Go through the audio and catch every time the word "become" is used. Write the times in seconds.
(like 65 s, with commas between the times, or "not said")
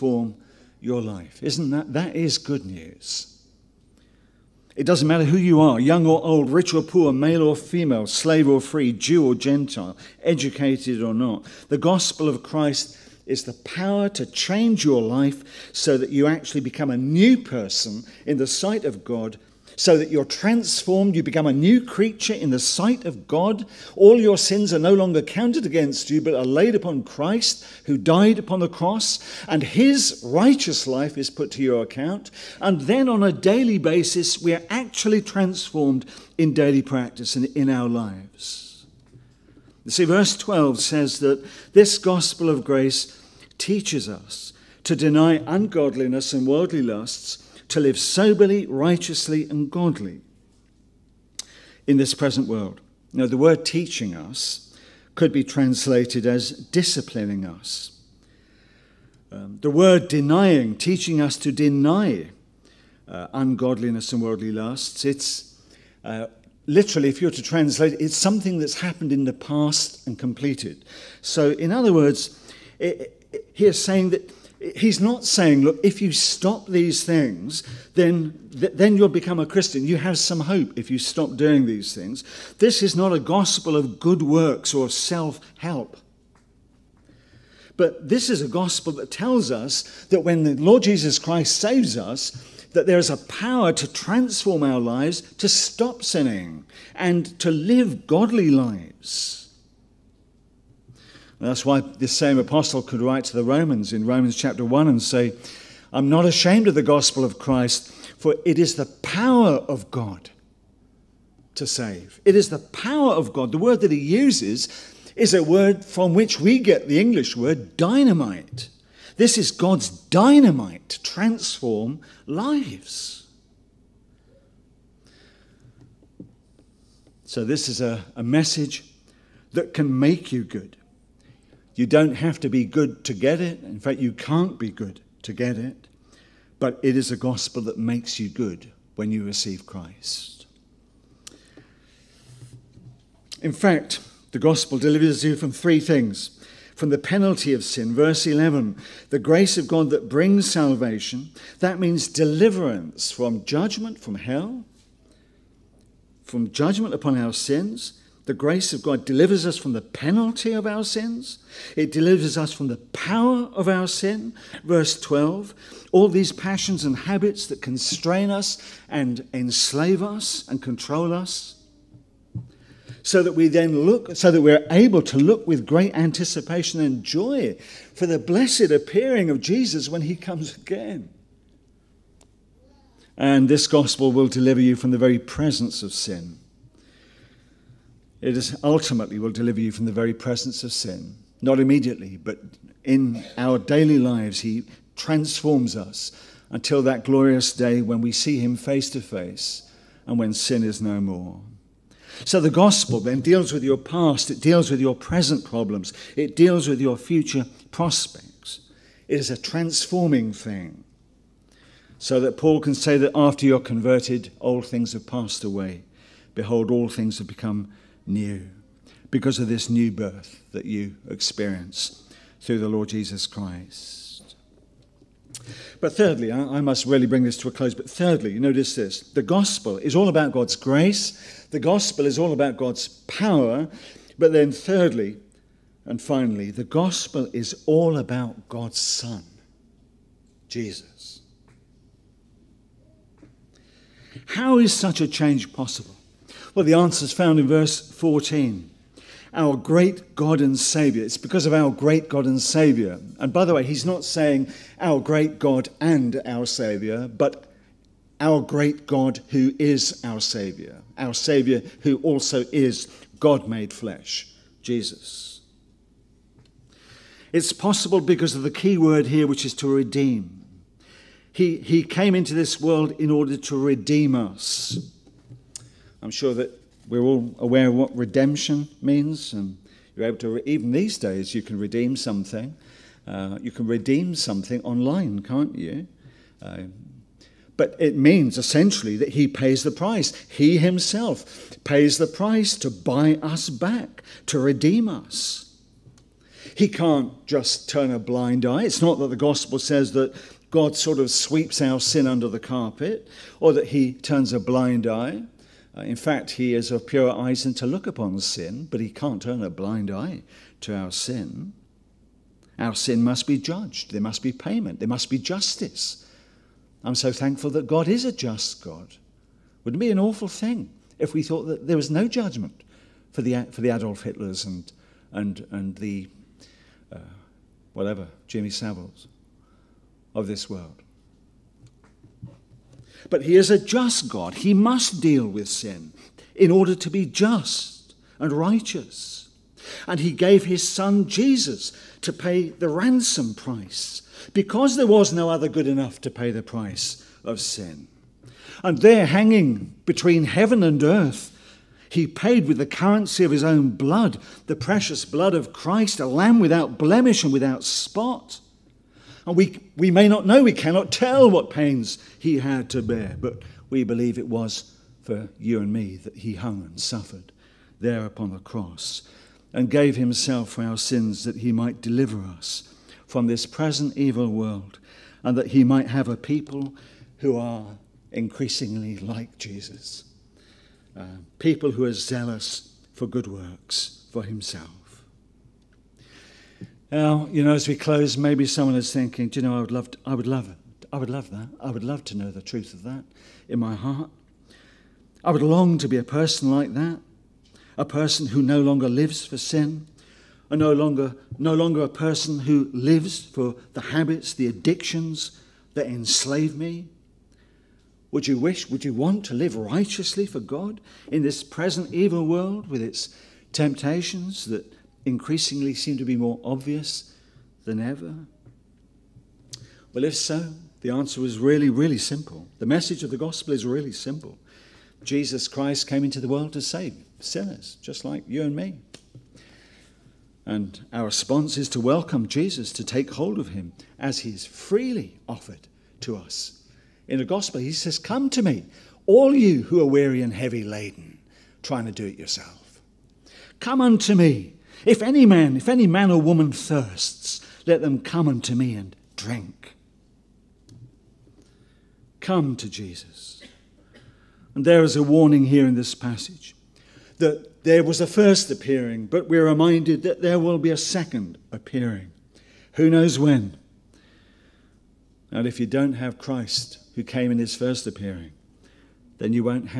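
16 s, 21 s, 79 s, 217 s.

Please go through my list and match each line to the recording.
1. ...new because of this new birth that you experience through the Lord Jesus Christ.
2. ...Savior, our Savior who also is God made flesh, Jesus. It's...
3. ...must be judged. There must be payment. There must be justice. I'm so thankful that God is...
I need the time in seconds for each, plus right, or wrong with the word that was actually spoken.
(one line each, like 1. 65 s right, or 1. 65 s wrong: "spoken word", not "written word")
1. 218 s right
2. 260 s right
3. 313 s right.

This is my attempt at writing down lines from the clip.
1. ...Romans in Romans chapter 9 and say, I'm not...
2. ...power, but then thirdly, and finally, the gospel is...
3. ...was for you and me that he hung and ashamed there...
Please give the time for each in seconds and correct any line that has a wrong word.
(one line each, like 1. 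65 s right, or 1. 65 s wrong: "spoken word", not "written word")
1. 103 s wrong: "1", not "9"
2. 233 s right
3. 364 s wrong: "suffered", not "ashamed".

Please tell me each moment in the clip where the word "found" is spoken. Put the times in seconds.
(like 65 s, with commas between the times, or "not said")
247 s.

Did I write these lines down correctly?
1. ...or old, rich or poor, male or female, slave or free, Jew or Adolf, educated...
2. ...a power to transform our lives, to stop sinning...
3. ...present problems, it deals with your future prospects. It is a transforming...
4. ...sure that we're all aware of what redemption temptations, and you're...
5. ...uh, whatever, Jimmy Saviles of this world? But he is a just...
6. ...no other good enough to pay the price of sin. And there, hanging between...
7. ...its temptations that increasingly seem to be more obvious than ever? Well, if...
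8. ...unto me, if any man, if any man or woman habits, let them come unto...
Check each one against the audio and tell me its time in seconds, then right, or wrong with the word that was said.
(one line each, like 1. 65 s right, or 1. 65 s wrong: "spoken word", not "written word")
1. 6 s wrong: "Gentile", not "Adolf"
2. 93 s right
3. 204 s right
4. 276 s wrong: "means", not "temptations"
5. 326 s right
6. 345 s right
7. 412 s right
8. 443 s wrong: "thirsts", not "habits".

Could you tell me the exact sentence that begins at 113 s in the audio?
The word that he uses is a word from which we get the English word dynamite.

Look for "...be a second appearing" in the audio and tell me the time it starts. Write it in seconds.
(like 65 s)
460 s.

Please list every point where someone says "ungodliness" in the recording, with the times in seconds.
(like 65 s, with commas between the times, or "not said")
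45 s, 63 s.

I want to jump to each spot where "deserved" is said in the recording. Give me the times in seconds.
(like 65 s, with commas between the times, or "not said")
not said.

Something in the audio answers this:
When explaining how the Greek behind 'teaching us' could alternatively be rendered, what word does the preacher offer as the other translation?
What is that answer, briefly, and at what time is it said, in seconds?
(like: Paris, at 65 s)
disciplining us, at 56 s.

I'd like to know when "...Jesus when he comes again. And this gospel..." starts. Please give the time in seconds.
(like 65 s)
179 s.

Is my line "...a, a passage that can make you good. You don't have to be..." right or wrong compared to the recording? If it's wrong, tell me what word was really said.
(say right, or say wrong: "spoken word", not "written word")
wrong: "message", not "passage".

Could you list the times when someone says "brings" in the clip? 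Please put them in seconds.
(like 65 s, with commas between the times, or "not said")
150 s, 227 s.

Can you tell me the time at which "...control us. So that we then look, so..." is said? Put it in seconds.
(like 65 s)
170 s.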